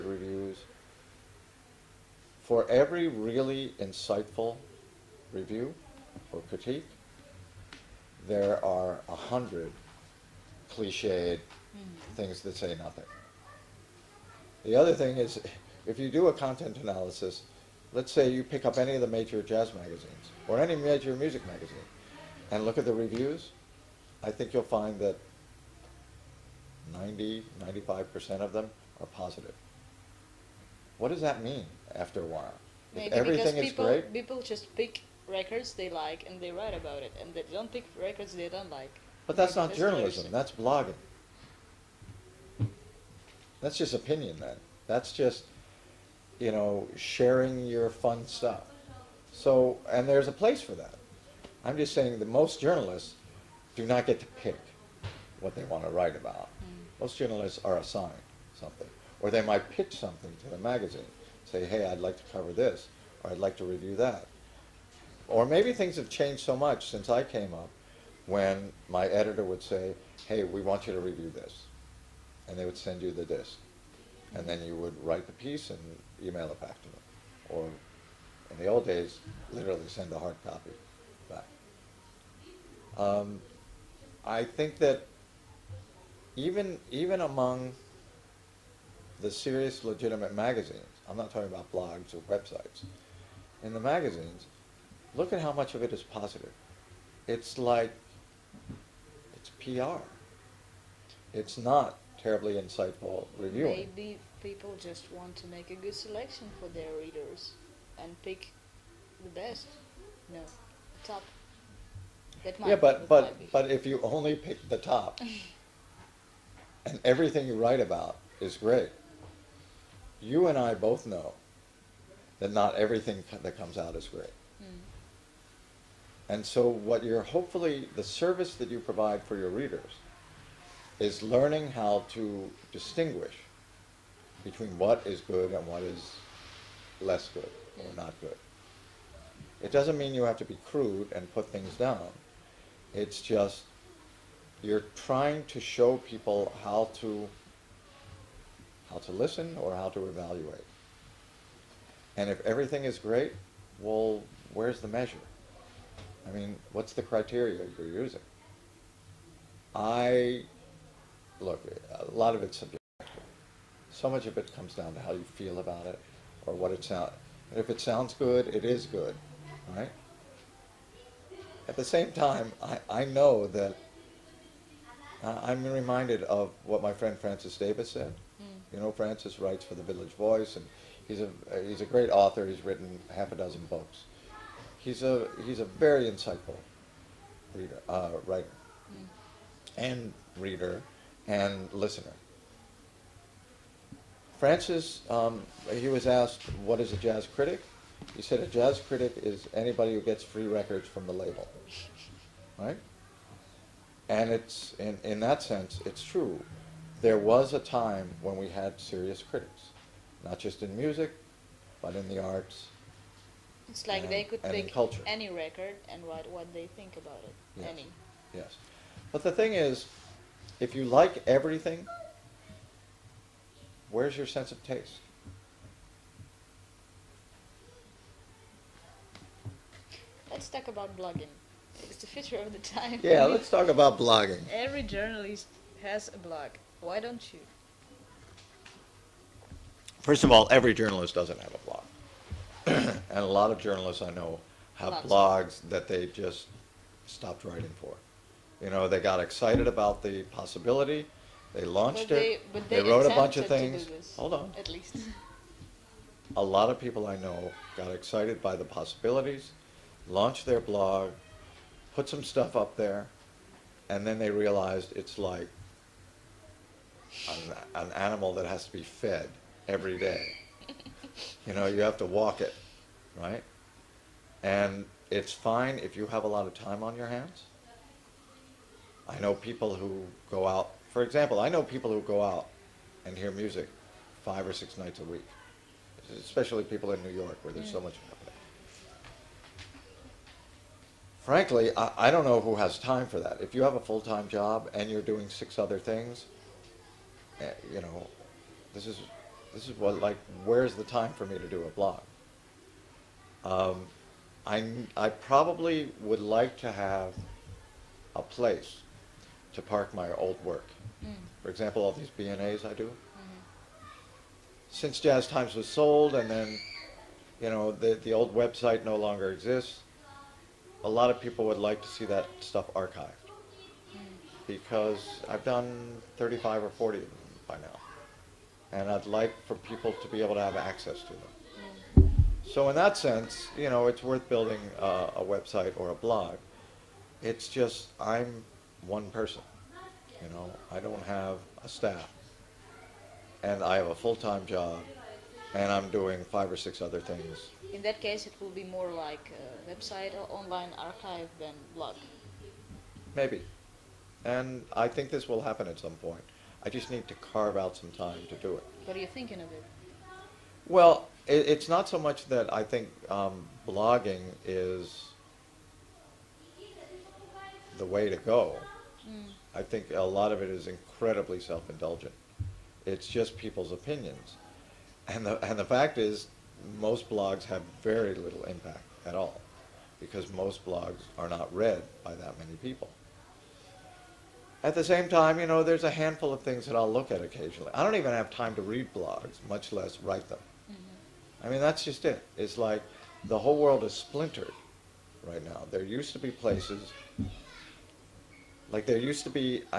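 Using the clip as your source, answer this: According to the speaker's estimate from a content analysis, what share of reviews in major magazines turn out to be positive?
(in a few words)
90-95%.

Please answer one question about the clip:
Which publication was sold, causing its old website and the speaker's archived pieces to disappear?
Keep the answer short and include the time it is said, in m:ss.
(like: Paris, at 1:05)
Jazz Times, at 5:14.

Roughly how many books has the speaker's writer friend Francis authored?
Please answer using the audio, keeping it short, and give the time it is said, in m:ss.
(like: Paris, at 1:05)
Half a dozen, at 3:03.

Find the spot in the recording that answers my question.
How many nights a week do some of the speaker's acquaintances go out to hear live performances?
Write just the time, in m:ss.
4:44.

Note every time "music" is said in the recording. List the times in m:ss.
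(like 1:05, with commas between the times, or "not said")
0:21, 3:30, 4:43.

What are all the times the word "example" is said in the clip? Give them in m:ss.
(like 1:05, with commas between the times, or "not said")
4:41, 5:11.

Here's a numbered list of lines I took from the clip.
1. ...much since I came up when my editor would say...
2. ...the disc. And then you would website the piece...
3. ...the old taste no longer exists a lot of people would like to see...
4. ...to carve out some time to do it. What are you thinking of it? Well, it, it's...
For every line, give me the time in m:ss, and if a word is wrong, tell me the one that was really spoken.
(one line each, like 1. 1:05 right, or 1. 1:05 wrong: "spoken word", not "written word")
1. 1:06 right
2. 1:13 wrong: "write", not "website"
3. 5:18 wrong: "website", not "taste"
4. 5:57 right.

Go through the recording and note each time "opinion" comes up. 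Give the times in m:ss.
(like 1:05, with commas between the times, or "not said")
0:43, 6:13.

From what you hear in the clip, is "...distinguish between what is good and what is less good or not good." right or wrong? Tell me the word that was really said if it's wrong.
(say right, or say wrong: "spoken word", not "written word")
right.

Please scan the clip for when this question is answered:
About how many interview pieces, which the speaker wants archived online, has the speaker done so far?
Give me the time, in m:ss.
5:26.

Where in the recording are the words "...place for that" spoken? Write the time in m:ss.
0:50.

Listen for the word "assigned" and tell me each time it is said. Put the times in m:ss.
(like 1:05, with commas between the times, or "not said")
0:57.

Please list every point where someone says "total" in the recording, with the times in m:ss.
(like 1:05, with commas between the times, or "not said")
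not said.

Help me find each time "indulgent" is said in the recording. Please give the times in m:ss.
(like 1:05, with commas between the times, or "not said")
6:11.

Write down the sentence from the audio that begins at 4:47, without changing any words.
so much frankly, I, I don't know who has time for that.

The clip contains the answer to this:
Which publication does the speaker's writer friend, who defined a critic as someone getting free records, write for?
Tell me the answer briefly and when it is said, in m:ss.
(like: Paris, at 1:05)
The Village Voice, at 2:59.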